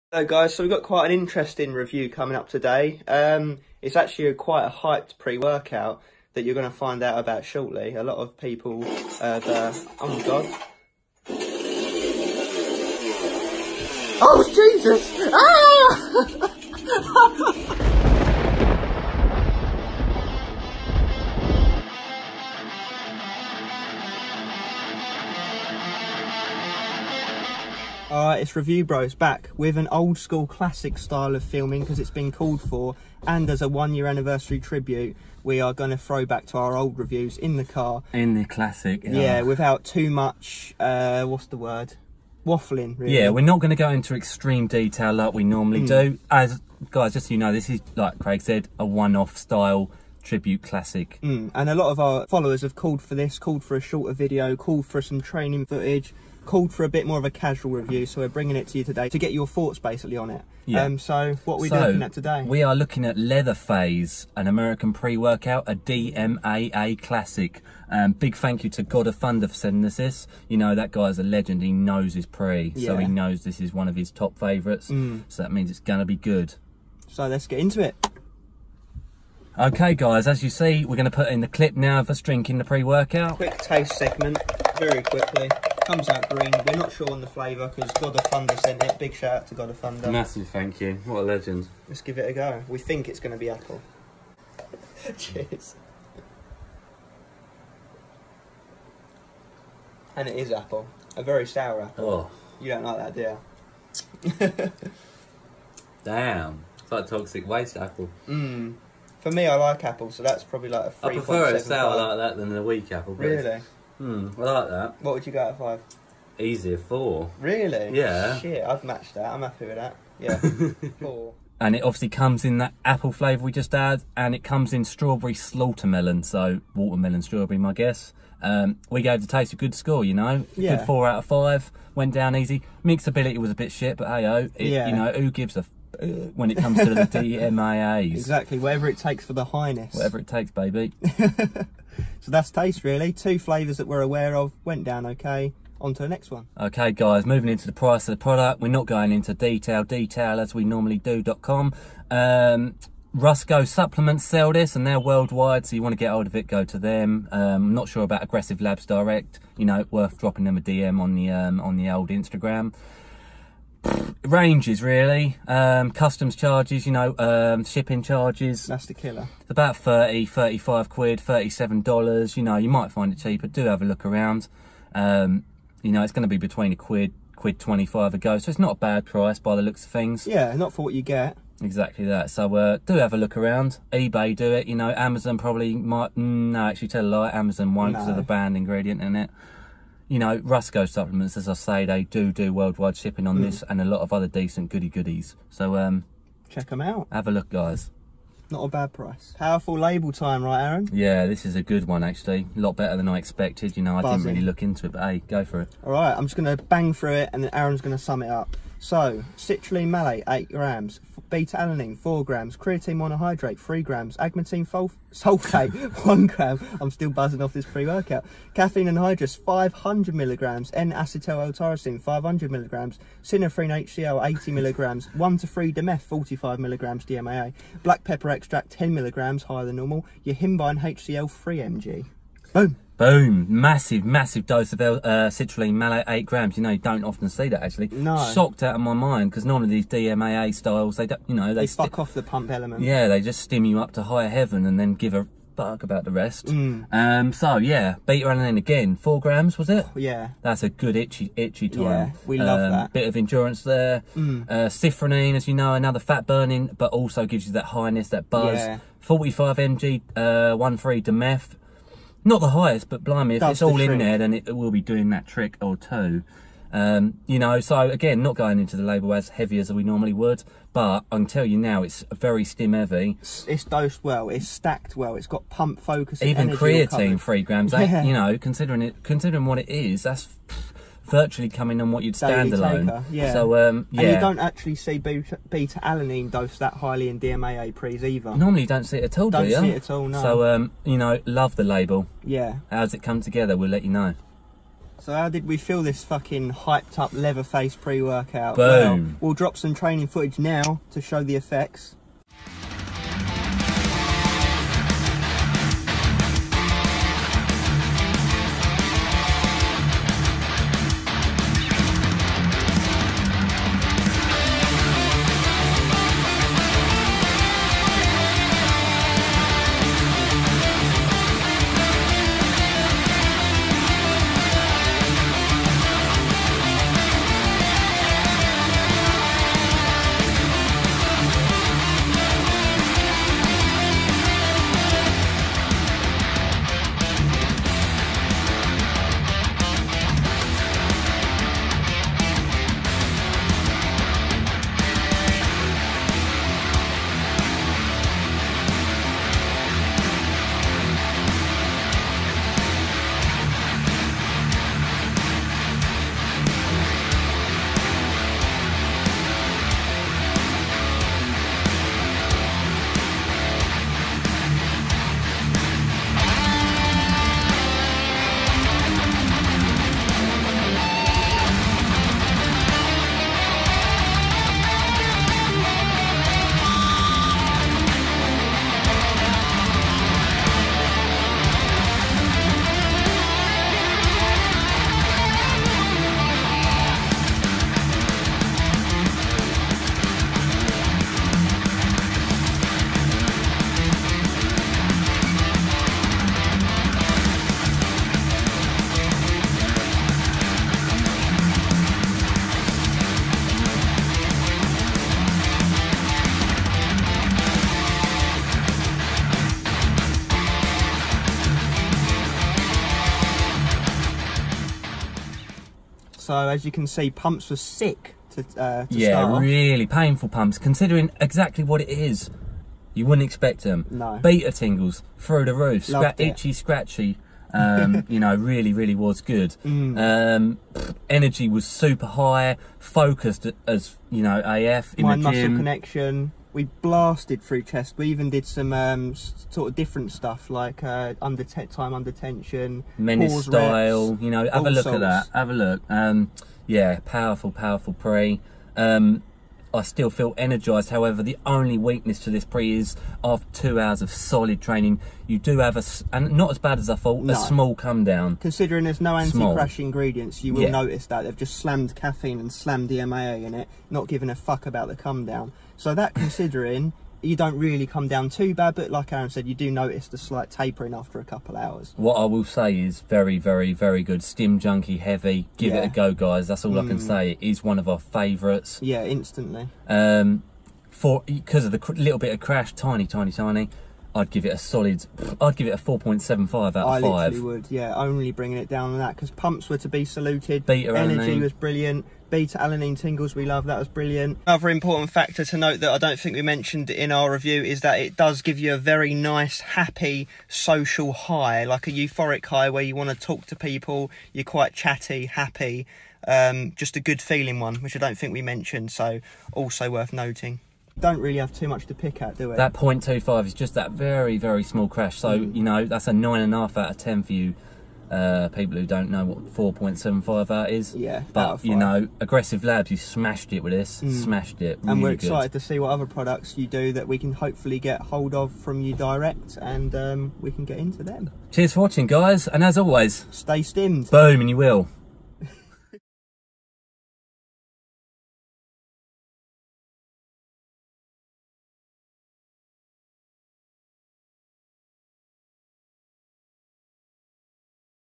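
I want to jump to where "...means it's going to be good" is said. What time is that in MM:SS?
01:15.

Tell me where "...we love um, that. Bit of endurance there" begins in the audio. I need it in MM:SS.
04:12.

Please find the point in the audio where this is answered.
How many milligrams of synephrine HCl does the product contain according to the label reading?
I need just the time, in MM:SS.
03:44.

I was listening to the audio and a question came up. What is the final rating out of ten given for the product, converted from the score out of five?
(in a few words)
9.5.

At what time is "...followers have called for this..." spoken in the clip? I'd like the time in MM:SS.
00:52.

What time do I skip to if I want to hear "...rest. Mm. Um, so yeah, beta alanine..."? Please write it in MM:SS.
04:06.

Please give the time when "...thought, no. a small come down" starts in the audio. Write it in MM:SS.
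07:36.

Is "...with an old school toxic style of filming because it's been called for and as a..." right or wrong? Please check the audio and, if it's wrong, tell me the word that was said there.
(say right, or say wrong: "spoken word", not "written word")
wrong: "classic", not "toxic".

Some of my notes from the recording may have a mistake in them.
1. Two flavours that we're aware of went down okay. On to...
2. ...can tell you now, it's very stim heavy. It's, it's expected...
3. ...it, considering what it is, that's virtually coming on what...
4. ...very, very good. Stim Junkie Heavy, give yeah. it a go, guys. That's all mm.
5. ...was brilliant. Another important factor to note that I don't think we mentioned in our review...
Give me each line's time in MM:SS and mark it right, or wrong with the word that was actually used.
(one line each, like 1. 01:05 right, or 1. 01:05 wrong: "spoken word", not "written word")
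1. 02:23 right
2. 04:31 wrong: "dosed", not "expected"
3. 04:38 right
4. 07:53 right
5. 08:13 right.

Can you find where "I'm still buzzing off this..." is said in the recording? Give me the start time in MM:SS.
03:36.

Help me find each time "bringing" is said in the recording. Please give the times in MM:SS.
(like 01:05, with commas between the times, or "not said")
00:58, 08:08.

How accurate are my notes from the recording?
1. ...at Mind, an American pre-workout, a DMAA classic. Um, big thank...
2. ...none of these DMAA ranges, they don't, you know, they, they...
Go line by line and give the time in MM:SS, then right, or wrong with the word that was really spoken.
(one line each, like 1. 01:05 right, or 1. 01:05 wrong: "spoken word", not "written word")
1. 01:03 wrong: "Leatherfaze", not "Mind"
2. 03:59 wrong: "styles", not "ranges".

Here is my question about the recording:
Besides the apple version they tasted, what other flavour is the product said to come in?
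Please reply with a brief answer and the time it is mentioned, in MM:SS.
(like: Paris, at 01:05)
strawberry melon, at 02:04.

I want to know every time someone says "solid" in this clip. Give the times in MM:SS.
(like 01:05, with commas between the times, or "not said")
07:34, 08:04.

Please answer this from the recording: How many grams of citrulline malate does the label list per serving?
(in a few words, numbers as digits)
8 grams.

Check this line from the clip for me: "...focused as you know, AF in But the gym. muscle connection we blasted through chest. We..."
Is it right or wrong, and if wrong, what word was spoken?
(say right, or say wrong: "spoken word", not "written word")
wrong: "Mind", not "But".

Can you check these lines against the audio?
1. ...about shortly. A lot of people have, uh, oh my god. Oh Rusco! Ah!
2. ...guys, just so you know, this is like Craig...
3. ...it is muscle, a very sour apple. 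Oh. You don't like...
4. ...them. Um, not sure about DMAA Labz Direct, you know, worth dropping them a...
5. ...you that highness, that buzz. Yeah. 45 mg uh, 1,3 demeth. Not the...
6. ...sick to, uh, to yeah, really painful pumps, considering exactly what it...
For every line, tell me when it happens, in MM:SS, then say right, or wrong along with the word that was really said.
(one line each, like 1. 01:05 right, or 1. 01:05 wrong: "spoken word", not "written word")
1. 00:07 wrong: "Jesus", not "Rusco"
2. 00:46 right
3. 01:40 wrong: "apple", not "muscle"
4. 02:36 wrong: "Aggressive", not "DMAA"
5. 04:17 right
6. 06:57 right.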